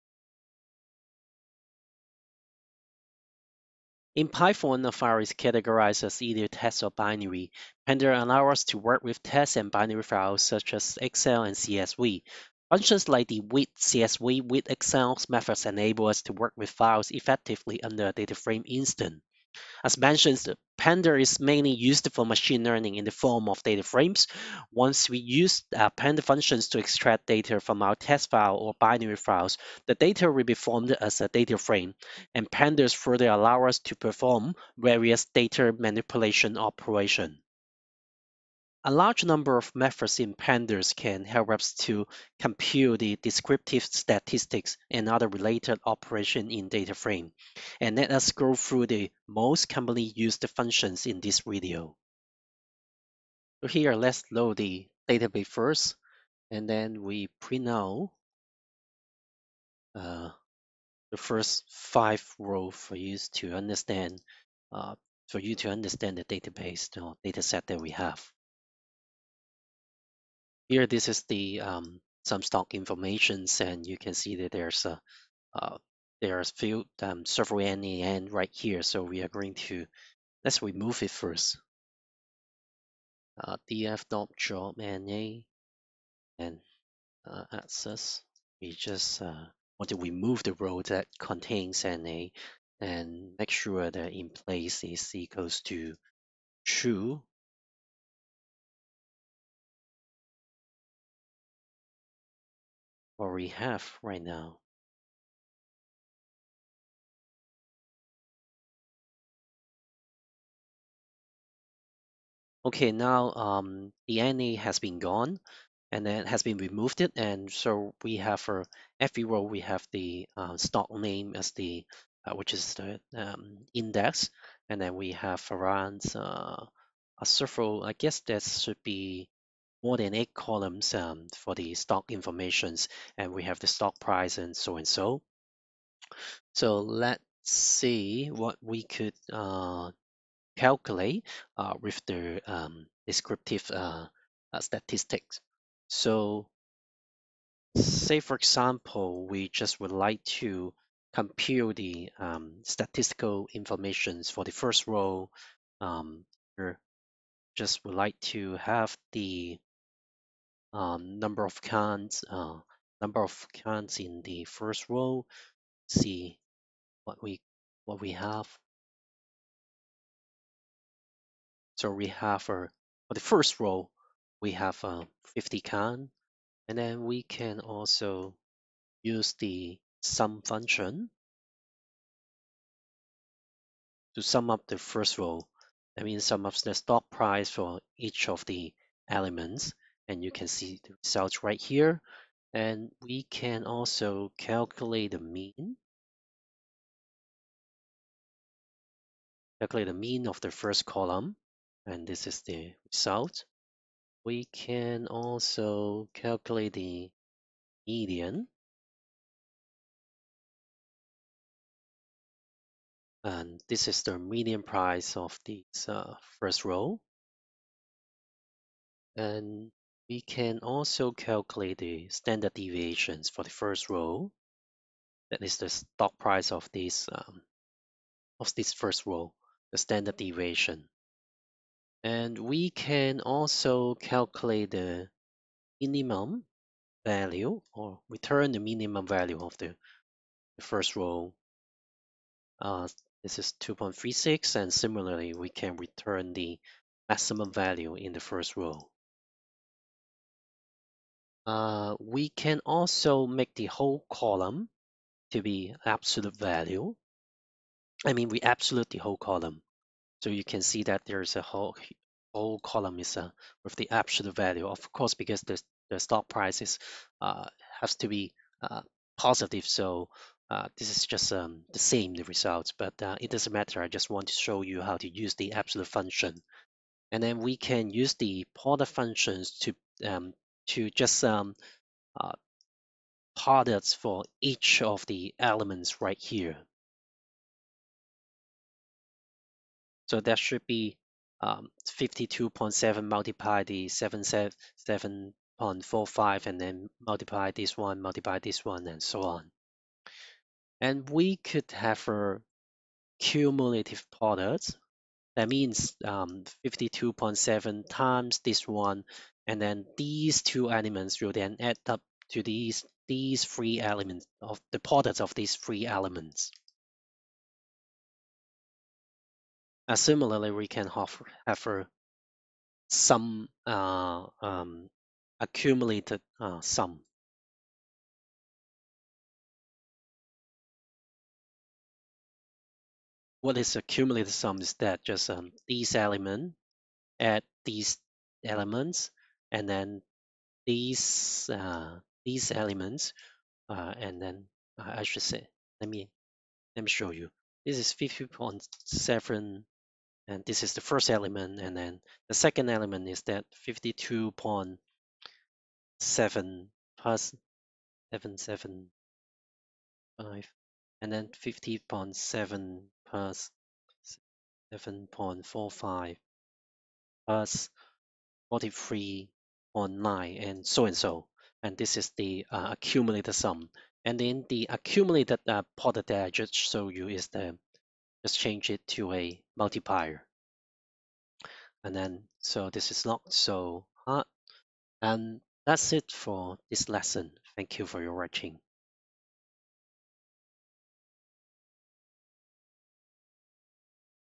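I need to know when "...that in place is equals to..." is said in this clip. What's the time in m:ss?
1:33.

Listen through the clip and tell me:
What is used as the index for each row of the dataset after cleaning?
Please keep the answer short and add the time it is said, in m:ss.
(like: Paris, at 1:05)
stock name, at 2:00.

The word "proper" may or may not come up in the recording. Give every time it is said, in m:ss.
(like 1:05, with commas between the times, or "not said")
not said.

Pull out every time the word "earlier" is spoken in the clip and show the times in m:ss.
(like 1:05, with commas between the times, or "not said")
not said.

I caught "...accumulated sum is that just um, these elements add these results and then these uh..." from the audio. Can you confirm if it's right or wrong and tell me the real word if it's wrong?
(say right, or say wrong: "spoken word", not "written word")
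wrong: "elements", not "results".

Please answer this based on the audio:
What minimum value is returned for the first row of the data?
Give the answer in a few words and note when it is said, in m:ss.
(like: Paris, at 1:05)
2.36, at 4:03.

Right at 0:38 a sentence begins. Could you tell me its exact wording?
A large number of methods in pandas can help us to compute the descriptive statistics and other related operation in data frame.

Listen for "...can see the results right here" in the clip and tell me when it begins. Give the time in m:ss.
3:10.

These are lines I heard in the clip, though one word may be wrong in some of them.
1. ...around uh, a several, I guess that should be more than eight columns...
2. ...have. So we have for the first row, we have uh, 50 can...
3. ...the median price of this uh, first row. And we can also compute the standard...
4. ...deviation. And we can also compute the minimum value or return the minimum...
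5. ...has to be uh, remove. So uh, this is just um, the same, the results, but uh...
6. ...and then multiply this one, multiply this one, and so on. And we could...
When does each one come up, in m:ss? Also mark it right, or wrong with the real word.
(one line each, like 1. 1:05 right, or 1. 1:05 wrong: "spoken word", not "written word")
1. 2:05 right
2. 2:48 right
3. 3:34 wrong: "calculate", not "compute"
4. 3:50 wrong: "calculate", not "compute"
5. 4:27 wrong: "positive", not "remove"
6. 4:56 right.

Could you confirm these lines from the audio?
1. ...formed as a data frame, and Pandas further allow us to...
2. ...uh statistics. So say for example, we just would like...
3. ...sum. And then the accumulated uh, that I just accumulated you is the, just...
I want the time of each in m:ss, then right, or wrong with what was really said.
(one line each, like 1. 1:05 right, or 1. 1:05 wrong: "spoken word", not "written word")
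1. 0:30 right
2. 2:24 right
3. 6:13 wrong: "showed", not "accumulated".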